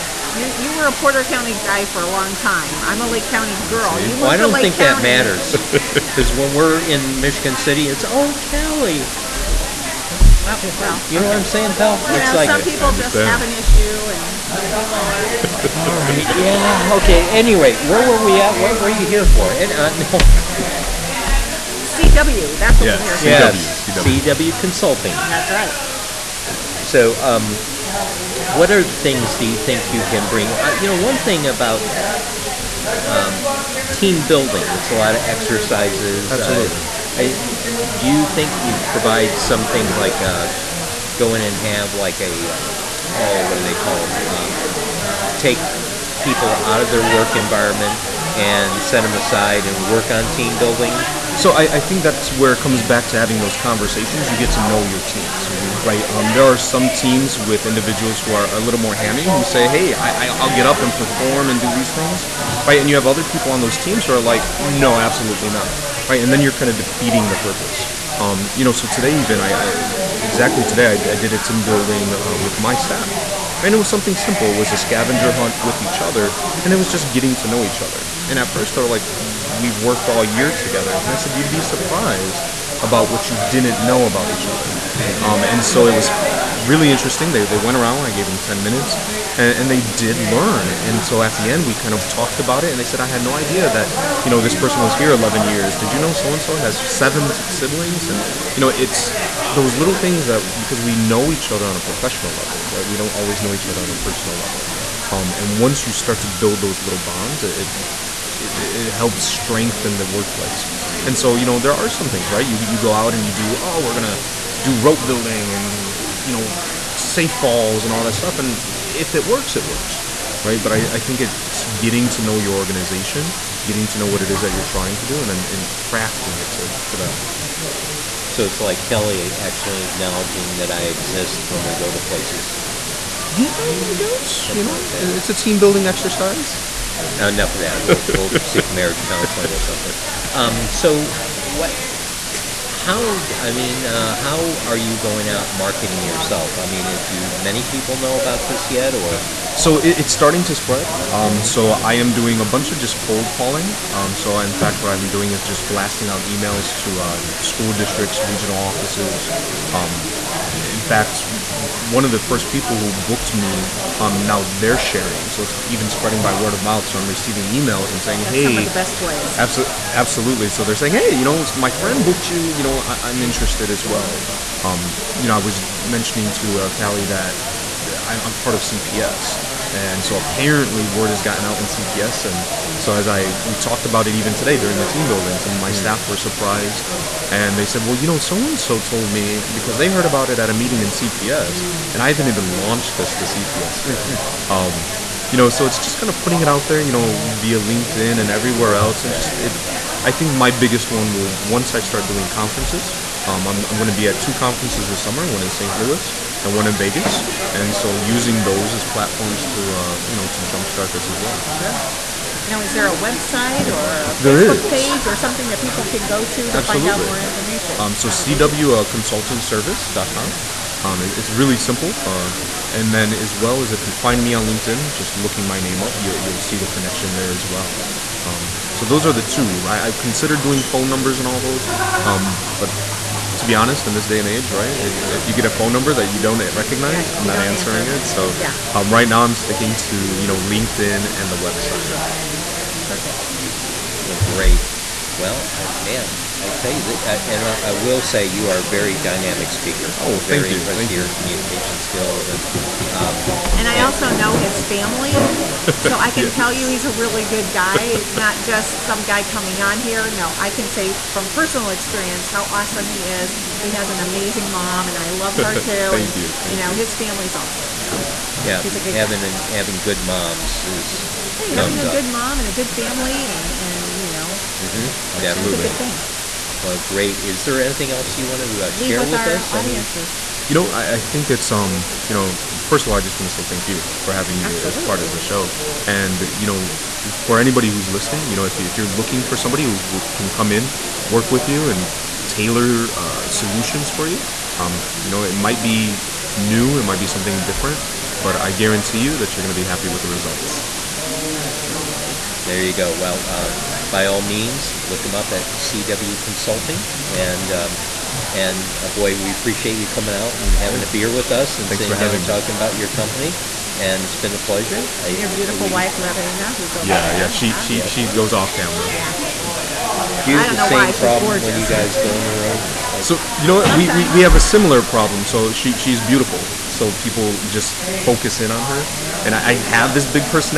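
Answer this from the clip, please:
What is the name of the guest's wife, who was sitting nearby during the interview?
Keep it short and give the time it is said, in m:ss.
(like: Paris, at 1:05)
Marina, at 5:15.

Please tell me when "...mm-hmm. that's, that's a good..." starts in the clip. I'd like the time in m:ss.
4:34.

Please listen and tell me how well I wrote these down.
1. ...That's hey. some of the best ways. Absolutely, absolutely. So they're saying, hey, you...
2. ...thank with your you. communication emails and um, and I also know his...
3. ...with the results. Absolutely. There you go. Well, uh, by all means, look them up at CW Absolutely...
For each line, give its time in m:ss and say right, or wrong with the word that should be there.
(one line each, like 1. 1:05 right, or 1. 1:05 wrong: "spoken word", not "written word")
1. 2:48 right
2. 4:10 wrong: "skills", not "emails"
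3. 4:59 wrong: "Consulting", not "Absolutely".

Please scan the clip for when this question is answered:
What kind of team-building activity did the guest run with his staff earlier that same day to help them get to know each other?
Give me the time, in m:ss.
1:14.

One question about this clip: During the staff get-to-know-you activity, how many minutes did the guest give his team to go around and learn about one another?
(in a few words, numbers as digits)
10.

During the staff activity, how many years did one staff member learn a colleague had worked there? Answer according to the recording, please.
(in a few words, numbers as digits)
11.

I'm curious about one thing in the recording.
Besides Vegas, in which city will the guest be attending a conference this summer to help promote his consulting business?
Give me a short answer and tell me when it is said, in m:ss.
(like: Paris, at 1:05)
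St. Louis, at 3:25.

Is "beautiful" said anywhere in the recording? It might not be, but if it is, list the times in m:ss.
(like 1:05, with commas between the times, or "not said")
5:15, 5:25.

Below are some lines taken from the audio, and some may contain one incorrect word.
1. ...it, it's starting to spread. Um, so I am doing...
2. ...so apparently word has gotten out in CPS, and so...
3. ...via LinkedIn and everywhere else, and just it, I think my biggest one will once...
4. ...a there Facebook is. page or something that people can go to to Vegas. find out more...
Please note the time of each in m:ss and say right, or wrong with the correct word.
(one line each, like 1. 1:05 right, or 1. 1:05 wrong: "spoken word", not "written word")
1. 2:29 right
2. 3:00 right
3. 3:17 right
4. 3:34 wrong: "Absolutely", not "Vegas".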